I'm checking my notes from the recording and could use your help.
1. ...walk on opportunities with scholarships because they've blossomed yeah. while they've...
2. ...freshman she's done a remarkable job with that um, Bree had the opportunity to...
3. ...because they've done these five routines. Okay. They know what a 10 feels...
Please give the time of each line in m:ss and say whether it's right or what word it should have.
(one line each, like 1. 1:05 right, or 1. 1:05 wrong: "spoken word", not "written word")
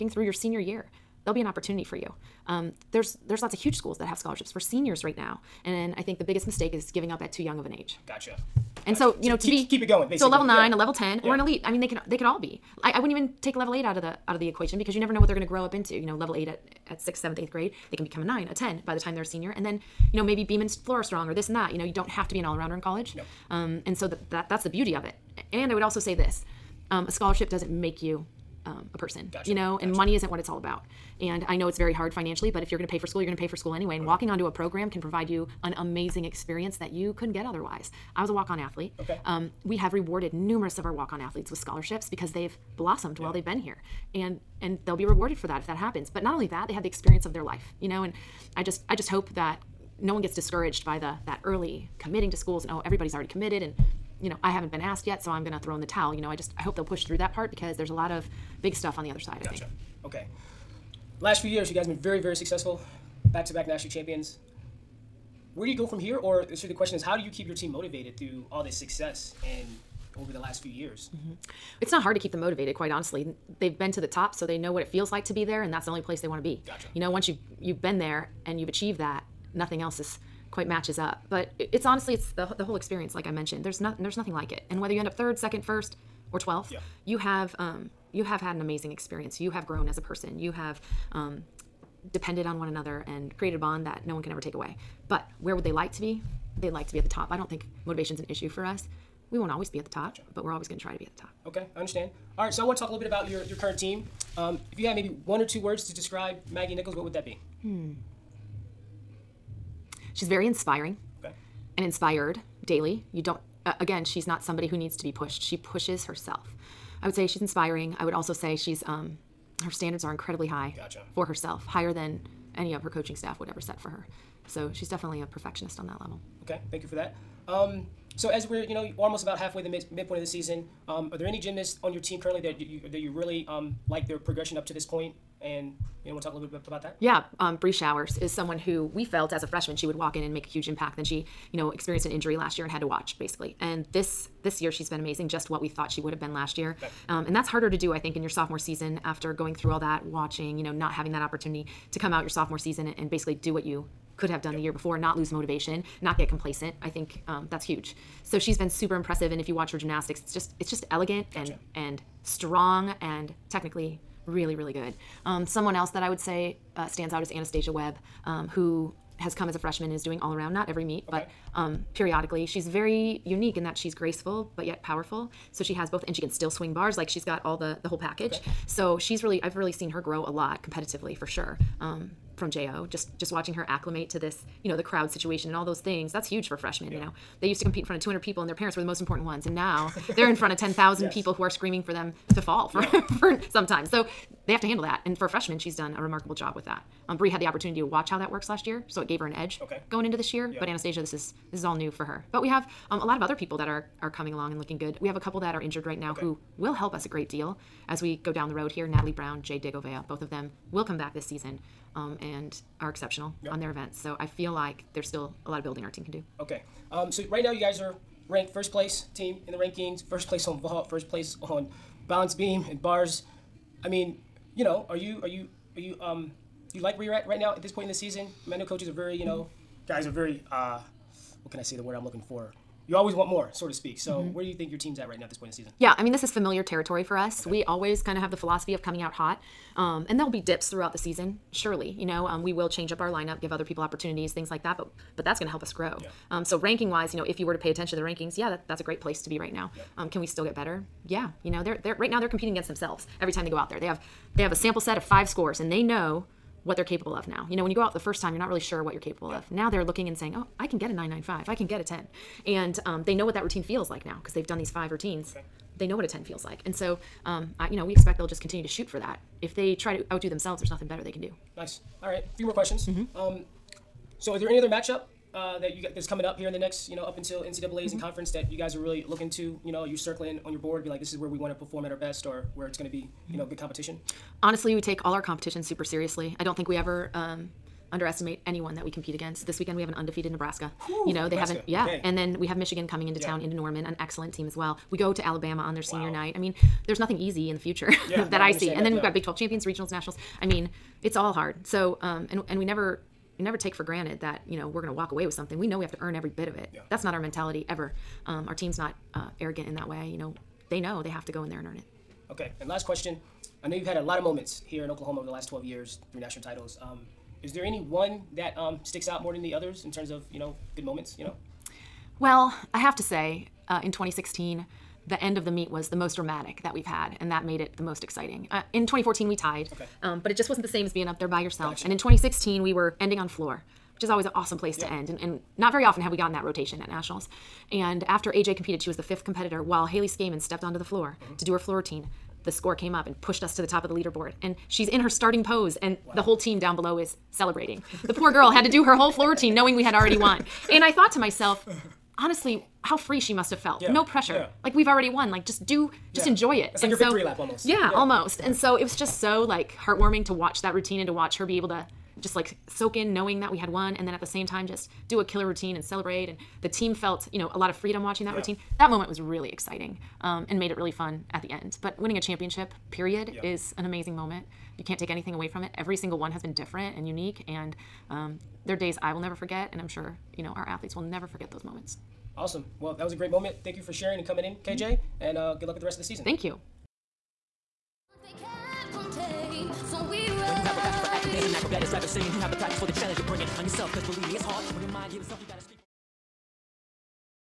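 1. 0:40 wrong: "athletes", not "opportunities"
2. 3:15 right
3. 4:24 right.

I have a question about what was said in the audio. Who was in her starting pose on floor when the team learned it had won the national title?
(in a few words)
Haley Scaman.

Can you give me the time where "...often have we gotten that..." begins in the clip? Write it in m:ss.
5:35.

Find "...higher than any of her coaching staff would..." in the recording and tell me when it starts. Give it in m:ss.
2:01.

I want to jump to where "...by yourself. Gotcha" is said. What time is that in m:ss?
5:31.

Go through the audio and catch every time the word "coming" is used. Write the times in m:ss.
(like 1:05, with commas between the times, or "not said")
3:24, 3:58, 4:36, 4:52, 6:24.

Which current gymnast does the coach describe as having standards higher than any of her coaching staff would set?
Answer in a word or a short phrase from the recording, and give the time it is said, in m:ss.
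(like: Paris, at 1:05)
Maggie Nichols, at 1:46.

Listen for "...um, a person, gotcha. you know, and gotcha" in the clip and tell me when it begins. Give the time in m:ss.
0:28.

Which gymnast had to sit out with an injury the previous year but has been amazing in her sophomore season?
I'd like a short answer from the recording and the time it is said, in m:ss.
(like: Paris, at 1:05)
Bree Showers, at 2:17.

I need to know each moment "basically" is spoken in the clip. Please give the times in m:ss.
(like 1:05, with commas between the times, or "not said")
0:10, 2:23, 2:33.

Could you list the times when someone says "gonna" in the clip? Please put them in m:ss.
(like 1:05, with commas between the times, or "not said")
0:55.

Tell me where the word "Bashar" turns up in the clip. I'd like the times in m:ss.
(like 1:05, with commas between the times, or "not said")
not said.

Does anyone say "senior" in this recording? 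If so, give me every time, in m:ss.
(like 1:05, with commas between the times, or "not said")
0:00, 0:04, 0:19, 4:55.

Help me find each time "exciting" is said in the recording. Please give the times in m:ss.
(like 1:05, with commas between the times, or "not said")
5:28, 6:09.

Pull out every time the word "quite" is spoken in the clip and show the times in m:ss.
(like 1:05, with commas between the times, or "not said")
1:12, 1:20.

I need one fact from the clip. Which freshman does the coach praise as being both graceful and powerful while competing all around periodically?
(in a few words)
Anastasia Webb.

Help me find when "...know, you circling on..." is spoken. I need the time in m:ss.
4:39.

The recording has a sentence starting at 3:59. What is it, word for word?
Um, and there'll be dips throughout the season, surely.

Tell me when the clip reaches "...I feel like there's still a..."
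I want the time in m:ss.
3:34.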